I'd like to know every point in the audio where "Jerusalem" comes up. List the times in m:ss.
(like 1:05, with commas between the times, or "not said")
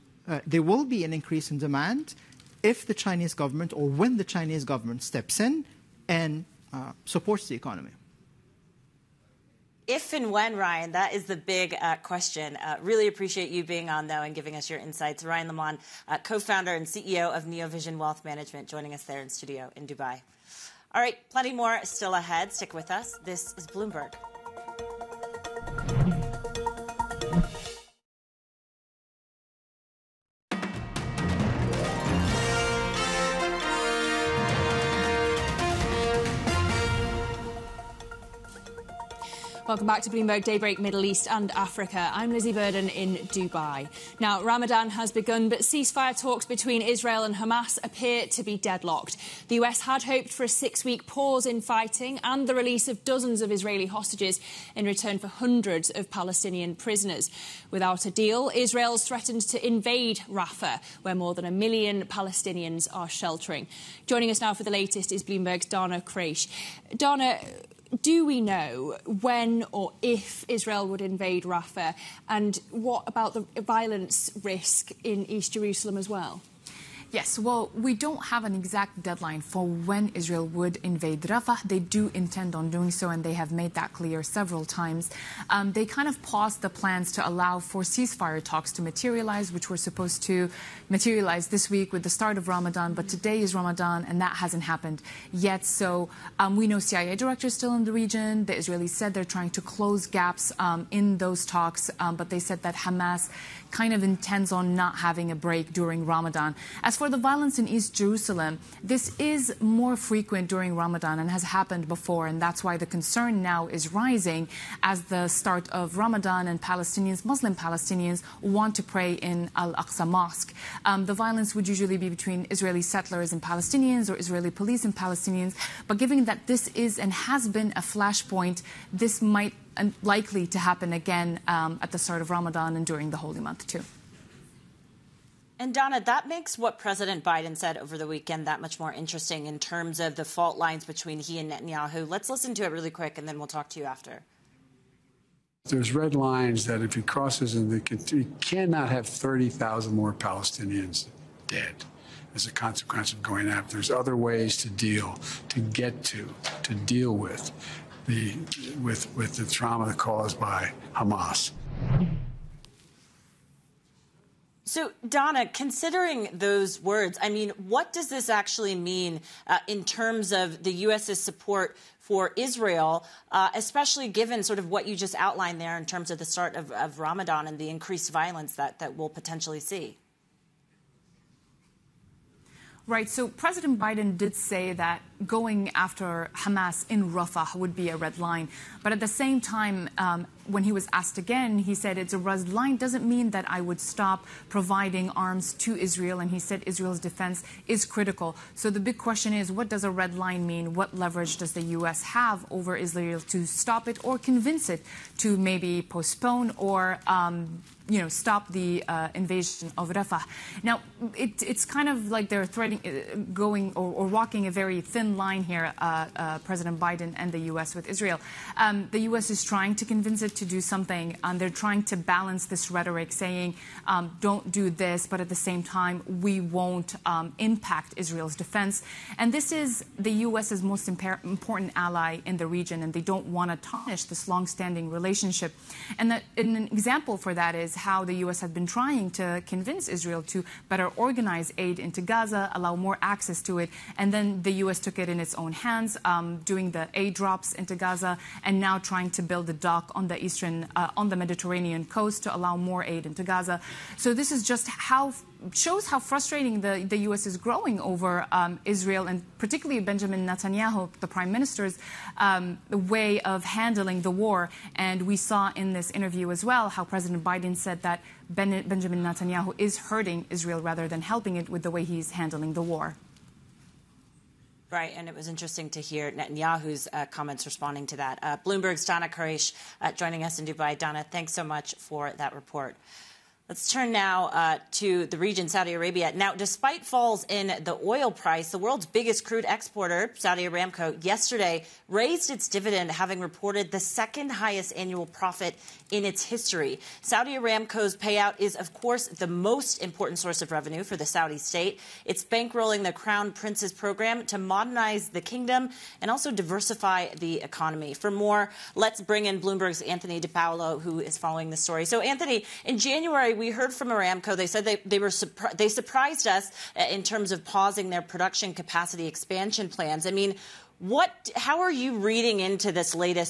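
1:15, 1:47.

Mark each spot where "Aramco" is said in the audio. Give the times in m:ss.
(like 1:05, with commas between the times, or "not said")
4:50, 4:57, 5:13.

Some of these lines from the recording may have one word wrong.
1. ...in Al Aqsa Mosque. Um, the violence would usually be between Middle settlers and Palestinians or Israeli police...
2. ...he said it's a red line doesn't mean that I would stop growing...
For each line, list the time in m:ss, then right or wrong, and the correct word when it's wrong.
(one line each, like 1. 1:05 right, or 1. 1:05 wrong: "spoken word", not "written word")
1. 1:59 wrong: "Israeli", not "Middle"
2. 3:11 wrong: "providing", not "growing".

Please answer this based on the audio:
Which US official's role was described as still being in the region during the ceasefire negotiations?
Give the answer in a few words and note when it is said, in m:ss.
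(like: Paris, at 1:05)
CIA director, at 1:36.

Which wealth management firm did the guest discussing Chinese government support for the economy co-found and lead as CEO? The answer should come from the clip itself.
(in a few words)
Neovision Wealth Management.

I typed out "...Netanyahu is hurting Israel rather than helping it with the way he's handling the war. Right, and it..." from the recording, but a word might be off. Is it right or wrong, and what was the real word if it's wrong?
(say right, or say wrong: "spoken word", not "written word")
right.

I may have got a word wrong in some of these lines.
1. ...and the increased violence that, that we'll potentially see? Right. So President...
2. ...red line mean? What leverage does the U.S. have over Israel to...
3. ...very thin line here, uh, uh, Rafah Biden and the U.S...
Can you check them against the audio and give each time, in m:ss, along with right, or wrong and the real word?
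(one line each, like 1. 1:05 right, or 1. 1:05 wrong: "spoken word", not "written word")
1. 2:57 right
2. 3:19 right
3. 3:34 wrong: "President", not "Rafah".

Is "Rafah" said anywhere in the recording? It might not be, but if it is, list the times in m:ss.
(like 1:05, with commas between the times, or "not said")
1:00, 1:11, 1:21, 3:07, 3:29.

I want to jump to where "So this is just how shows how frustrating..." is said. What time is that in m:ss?
4:13.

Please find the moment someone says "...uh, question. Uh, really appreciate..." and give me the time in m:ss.
0:11.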